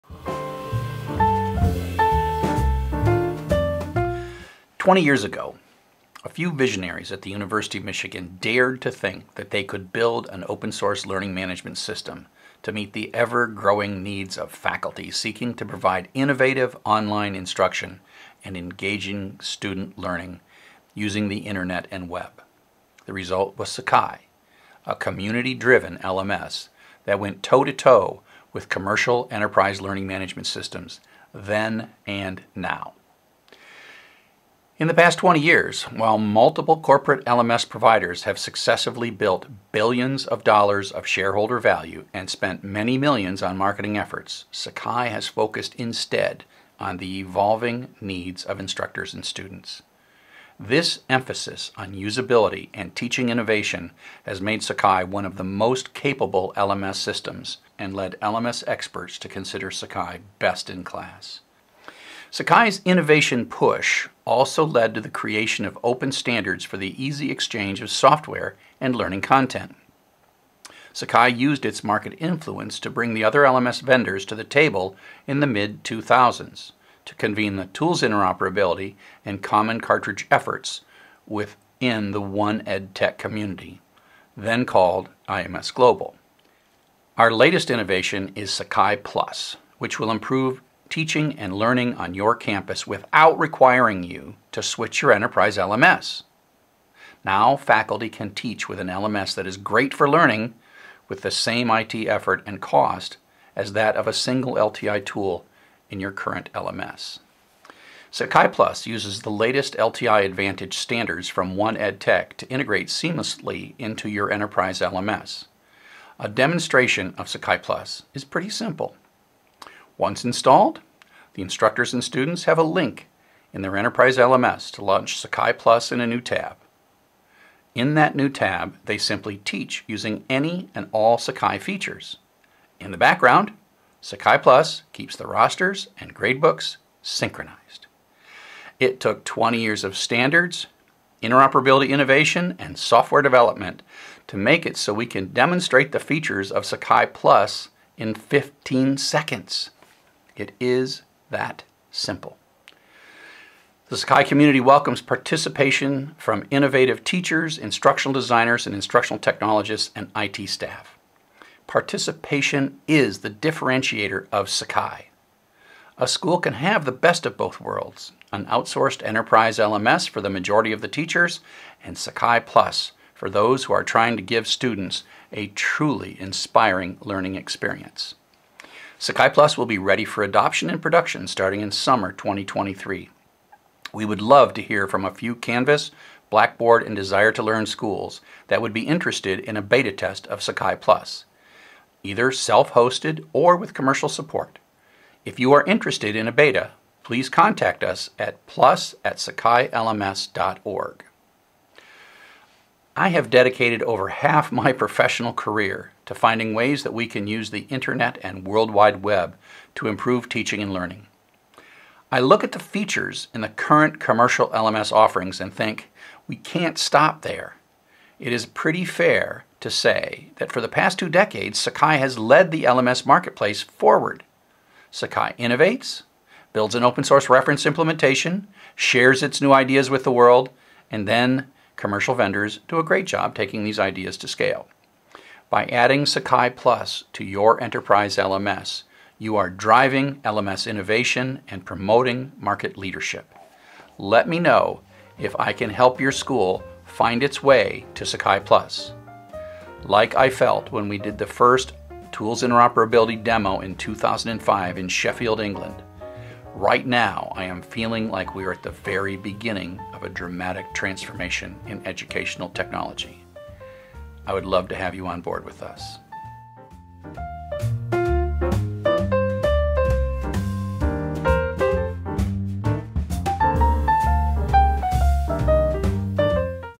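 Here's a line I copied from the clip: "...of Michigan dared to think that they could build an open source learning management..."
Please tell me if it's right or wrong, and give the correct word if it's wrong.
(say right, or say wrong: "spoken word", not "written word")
right.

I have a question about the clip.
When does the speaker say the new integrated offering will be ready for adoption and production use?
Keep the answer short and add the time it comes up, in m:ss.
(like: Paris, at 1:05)
summer 2023, at 3:01.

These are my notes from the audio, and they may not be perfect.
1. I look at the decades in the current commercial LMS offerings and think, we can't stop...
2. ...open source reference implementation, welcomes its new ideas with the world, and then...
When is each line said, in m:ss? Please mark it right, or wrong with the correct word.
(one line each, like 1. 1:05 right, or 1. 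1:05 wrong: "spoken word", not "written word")
1. 3:32 wrong: "features", not "decades"
2. 3:46 wrong: "shares", not "welcomes".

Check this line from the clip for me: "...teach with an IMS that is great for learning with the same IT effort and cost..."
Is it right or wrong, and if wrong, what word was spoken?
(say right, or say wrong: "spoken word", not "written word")
wrong: "LMS", not "IMS".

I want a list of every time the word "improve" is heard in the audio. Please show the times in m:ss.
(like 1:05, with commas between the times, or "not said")
1:30, 3:29.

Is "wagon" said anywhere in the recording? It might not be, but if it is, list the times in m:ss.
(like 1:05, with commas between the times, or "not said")
not said.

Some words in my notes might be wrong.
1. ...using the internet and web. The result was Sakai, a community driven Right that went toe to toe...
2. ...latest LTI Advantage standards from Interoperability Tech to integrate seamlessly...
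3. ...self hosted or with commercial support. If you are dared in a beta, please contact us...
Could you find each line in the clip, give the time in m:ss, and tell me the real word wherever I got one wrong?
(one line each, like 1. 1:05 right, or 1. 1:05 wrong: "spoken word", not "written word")
1. 0:20 wrong: "LMS", not "Right"
2. 1:49 wrong: "One", not "Interoperability"
3. 3:12 wrong: "interested", not "dared".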